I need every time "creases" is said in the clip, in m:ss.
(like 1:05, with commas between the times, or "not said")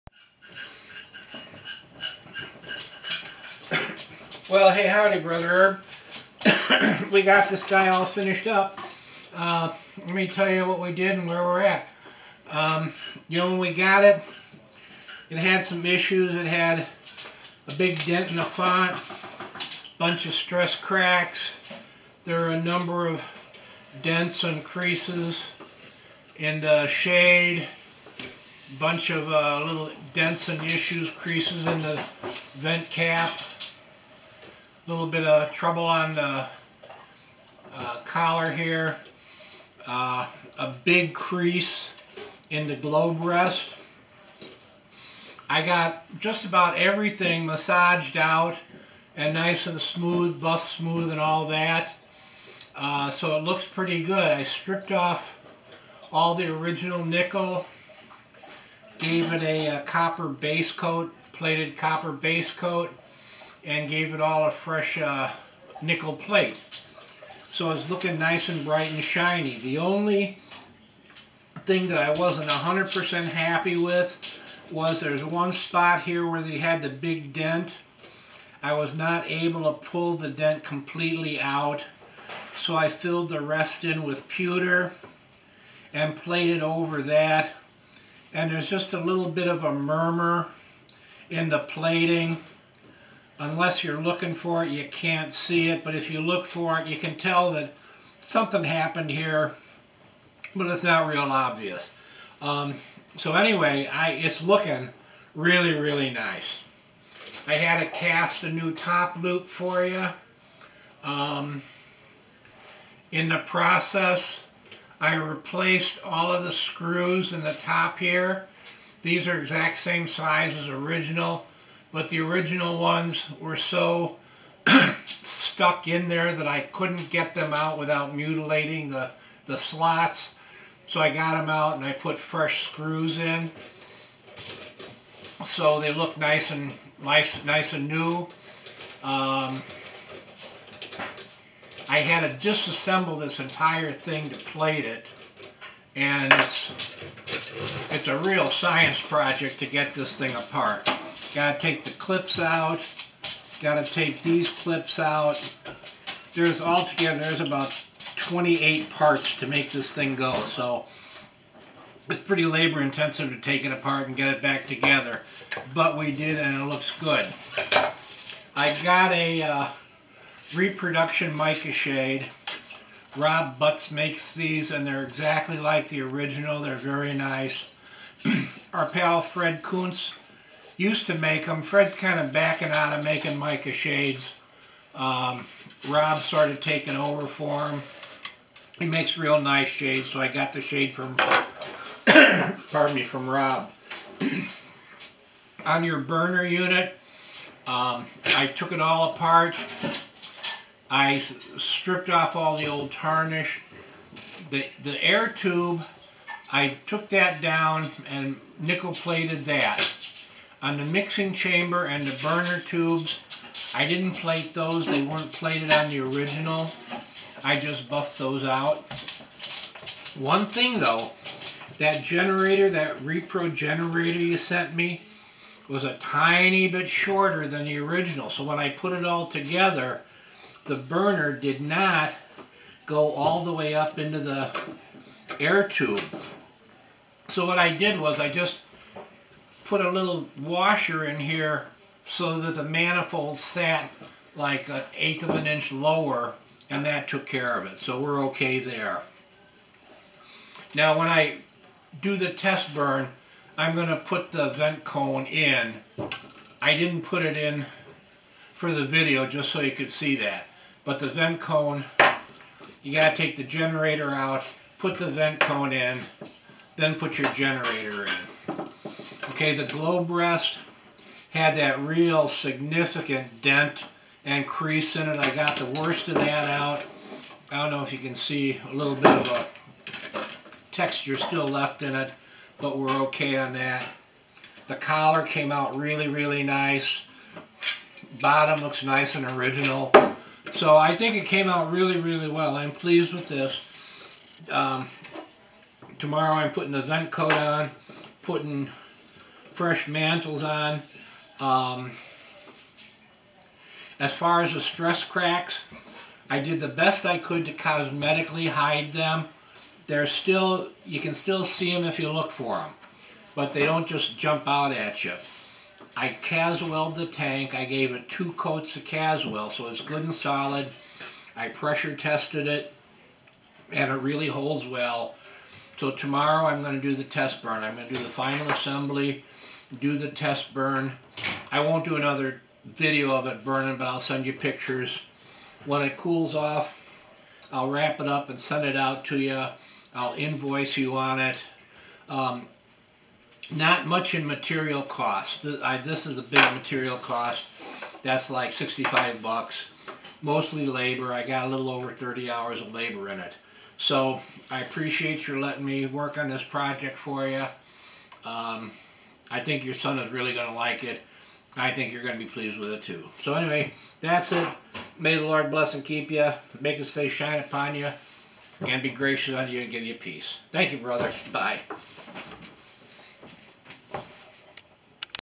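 0:24, 0:31, 0:41, 4:34.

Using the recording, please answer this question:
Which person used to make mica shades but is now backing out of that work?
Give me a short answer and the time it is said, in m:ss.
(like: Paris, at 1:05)
Fred Kuntz, at 2:59.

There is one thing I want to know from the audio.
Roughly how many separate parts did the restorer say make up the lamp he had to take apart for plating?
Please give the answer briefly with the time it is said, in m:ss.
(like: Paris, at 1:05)
28, at 2:38.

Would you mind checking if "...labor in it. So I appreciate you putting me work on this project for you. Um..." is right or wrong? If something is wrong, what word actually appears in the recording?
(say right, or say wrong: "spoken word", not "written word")
wrong: "letting", not "putting".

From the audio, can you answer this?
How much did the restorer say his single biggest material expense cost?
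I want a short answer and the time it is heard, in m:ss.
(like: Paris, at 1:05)
$65, at 5:48.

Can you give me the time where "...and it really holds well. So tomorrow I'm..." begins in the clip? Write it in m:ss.
5:23.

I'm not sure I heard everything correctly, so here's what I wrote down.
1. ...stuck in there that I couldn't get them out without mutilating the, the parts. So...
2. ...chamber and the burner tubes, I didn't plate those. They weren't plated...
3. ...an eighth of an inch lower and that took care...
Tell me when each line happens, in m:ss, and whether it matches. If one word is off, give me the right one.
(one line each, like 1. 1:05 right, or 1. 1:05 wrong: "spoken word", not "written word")
1. 2:05 wrong: "slots", not "parts"
2. 3:31 right
3. 4:04 right.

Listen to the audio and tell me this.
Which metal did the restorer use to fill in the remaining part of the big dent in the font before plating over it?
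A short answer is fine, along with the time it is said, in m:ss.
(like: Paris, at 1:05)
pewter, at 1:24.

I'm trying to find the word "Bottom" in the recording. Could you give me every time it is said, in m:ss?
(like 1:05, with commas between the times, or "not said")
4:48.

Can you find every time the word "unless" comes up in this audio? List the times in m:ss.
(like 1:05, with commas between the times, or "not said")
1:33.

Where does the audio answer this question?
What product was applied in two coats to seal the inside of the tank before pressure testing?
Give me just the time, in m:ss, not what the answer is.
5:18.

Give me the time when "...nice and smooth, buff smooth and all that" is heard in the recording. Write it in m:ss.
0:49.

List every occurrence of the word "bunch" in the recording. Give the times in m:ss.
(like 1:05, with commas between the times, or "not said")
0:19, 0:28.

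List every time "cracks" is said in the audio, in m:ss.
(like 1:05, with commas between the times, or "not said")
0:20, 5:05.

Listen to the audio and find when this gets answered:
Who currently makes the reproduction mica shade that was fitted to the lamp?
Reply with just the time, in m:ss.
2:53.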